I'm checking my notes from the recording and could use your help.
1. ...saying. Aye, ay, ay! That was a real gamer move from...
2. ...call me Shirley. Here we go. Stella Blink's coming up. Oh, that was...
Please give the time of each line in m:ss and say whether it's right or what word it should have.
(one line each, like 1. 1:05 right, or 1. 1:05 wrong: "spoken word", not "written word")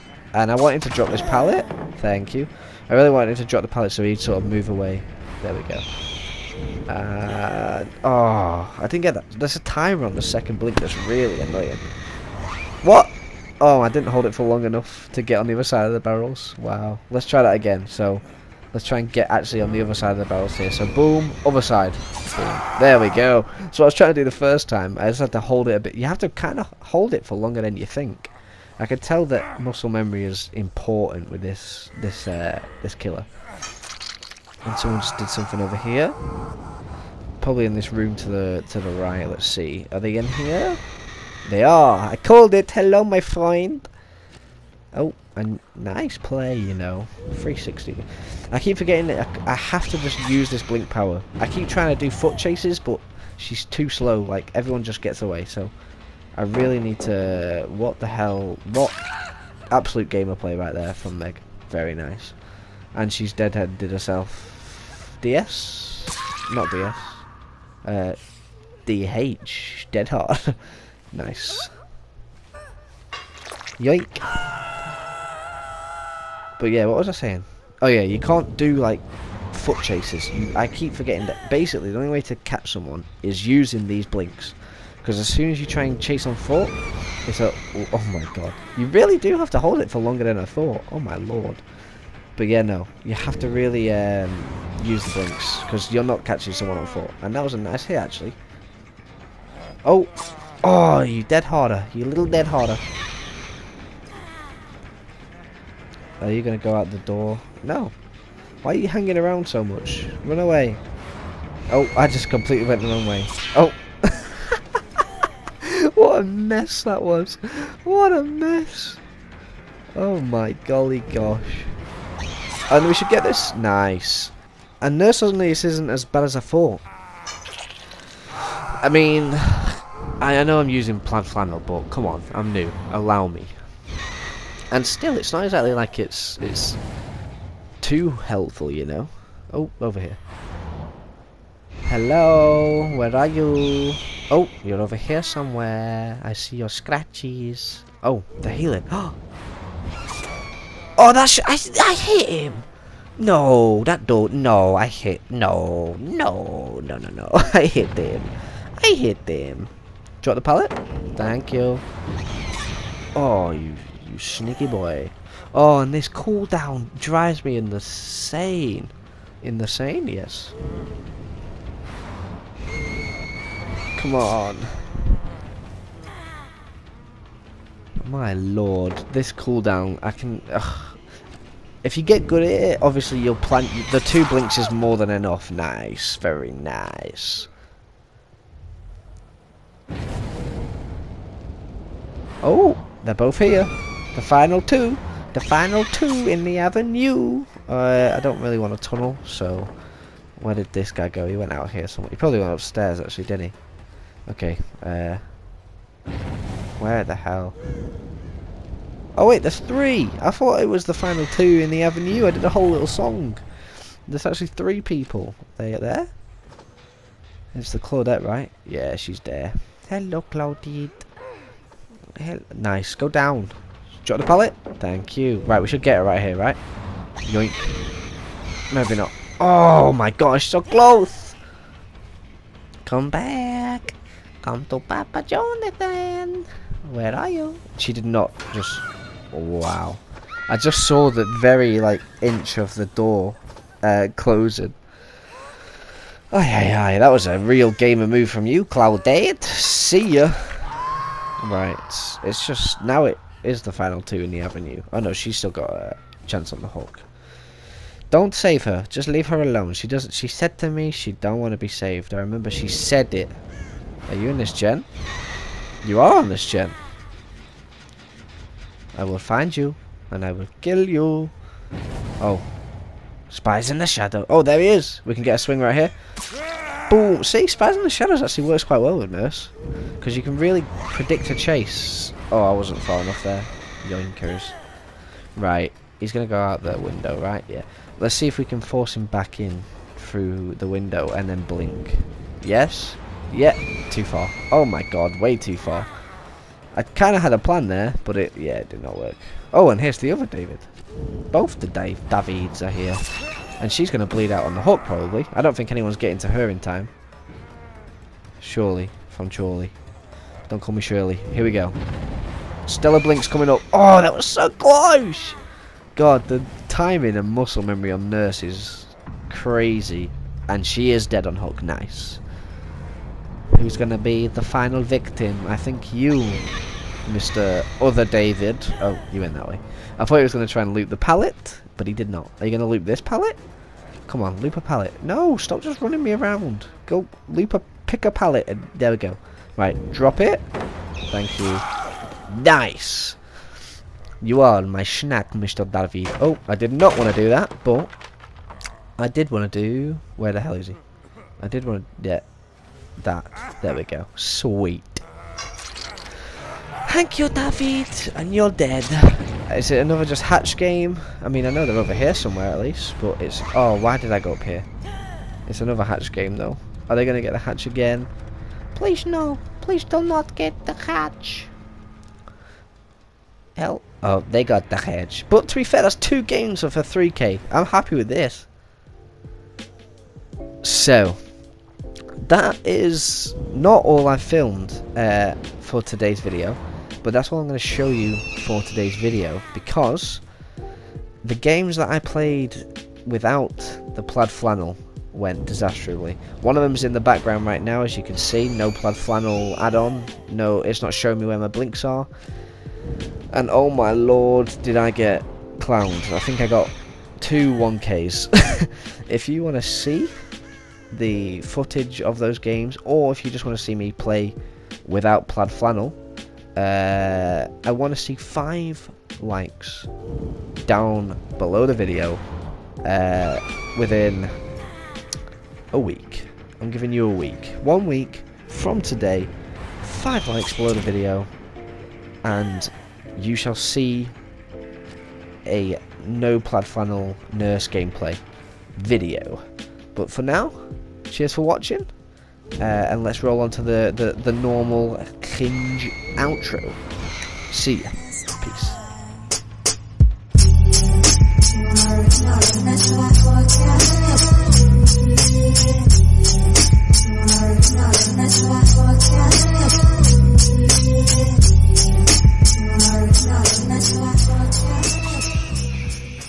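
1. 4:04 wrong: "closing", not "saying"
2. 5:10 right.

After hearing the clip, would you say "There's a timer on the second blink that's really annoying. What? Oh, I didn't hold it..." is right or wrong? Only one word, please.
right.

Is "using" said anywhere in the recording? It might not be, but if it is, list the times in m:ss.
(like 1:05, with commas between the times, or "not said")
1:23, 2:10.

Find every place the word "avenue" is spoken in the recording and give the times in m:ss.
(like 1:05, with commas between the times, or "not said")
3:16, 3:31, 4:14.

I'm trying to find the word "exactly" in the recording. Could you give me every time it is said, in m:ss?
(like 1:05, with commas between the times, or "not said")
2:15.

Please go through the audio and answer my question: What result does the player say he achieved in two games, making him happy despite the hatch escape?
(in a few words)
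3k.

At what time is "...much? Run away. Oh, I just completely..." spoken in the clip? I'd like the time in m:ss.
1:49.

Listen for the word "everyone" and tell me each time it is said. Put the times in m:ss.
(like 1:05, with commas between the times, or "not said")
0:54.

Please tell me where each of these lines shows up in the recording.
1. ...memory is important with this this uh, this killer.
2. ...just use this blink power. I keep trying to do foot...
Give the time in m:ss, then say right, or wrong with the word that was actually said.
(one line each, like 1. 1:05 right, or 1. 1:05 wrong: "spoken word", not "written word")
1. 0:29 right
2. 0:49 right.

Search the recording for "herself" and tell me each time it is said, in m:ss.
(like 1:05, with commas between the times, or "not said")
1:03.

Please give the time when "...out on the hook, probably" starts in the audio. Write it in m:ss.
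5:04.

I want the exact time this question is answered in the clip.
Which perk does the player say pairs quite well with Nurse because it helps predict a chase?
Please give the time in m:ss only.
4:37.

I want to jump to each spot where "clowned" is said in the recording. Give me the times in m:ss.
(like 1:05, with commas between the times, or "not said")
6:45.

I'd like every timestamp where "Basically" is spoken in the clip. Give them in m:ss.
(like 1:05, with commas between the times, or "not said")
1:21.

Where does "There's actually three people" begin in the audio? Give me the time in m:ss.
3:34.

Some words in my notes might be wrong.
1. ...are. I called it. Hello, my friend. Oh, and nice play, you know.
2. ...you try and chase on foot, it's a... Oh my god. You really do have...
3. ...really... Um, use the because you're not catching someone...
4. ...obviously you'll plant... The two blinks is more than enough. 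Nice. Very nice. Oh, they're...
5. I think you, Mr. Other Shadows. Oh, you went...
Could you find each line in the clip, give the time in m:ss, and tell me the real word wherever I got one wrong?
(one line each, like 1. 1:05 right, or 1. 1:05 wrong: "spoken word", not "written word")
1. 0:41 right
2. 1:25 right
3. 1:33 right
4. 3:02 right
5. 5:25 wrong: "David", not "Shadows".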